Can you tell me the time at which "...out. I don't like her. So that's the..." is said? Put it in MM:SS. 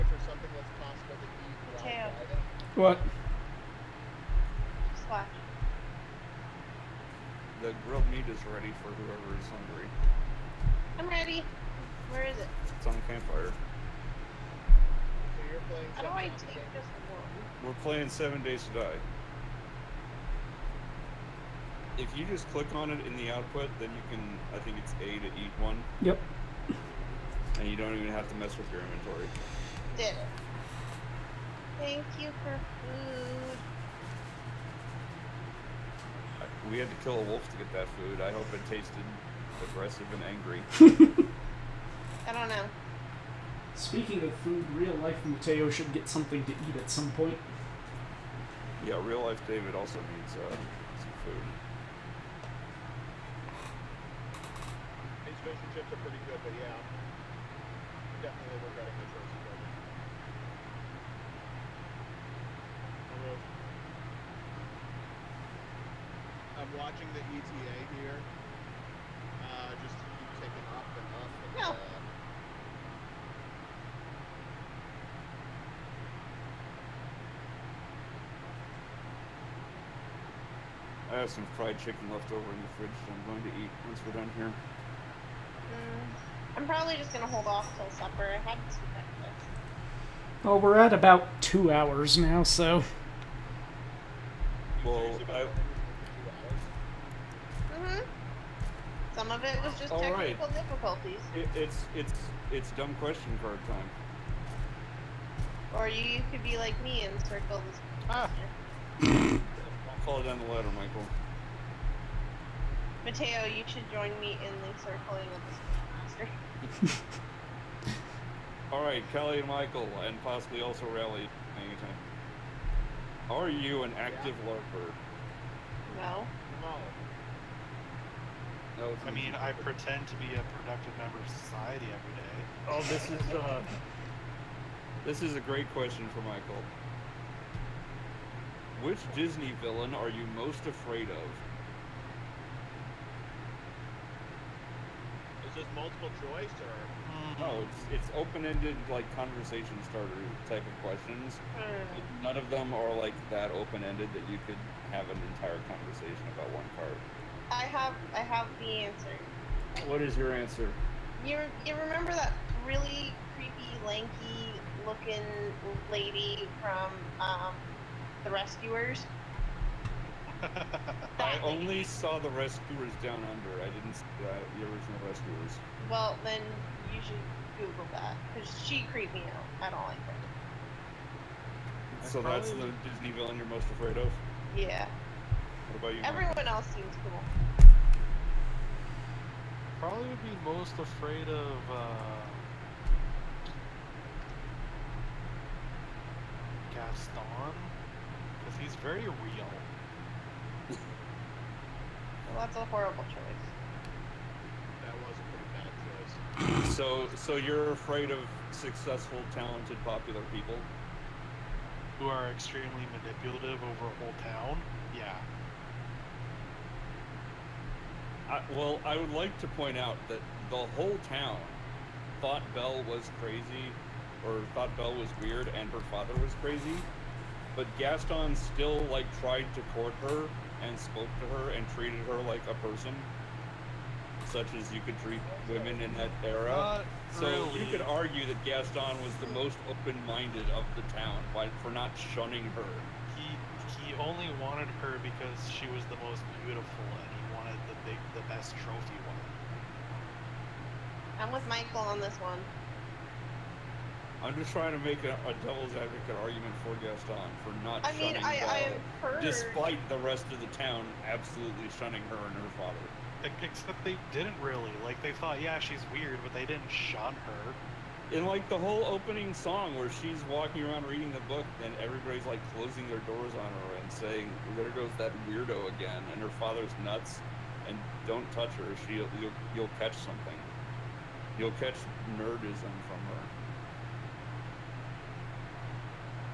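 02:59.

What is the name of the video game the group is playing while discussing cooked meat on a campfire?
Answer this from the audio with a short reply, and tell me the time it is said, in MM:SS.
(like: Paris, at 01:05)
Seven Days to Die, at 00:18.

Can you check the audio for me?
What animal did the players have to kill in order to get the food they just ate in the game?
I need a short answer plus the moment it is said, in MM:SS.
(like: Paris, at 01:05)
A wolf, at 00:37.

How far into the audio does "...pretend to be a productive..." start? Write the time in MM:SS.
02:09.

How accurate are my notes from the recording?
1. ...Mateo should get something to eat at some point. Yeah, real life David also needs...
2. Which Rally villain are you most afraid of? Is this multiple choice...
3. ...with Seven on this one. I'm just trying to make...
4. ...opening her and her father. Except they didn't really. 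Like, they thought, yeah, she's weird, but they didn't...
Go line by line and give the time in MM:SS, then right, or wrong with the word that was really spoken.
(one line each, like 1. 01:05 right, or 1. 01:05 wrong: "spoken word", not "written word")
1. 00:45 right
2. 02:18 wrong: "Disney", not "Rally"
3. 04:11 wrong: "Michael", not "Seven"
4. 04:21 wrong: "shunning", not "opening".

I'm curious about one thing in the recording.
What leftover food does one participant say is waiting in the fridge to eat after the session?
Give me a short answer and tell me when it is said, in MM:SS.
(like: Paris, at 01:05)
Fried chicken, at 01:21.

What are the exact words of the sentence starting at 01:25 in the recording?
Mm, I'm probably just going to hold off till supper.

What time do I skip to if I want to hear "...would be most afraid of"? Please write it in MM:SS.
03:10.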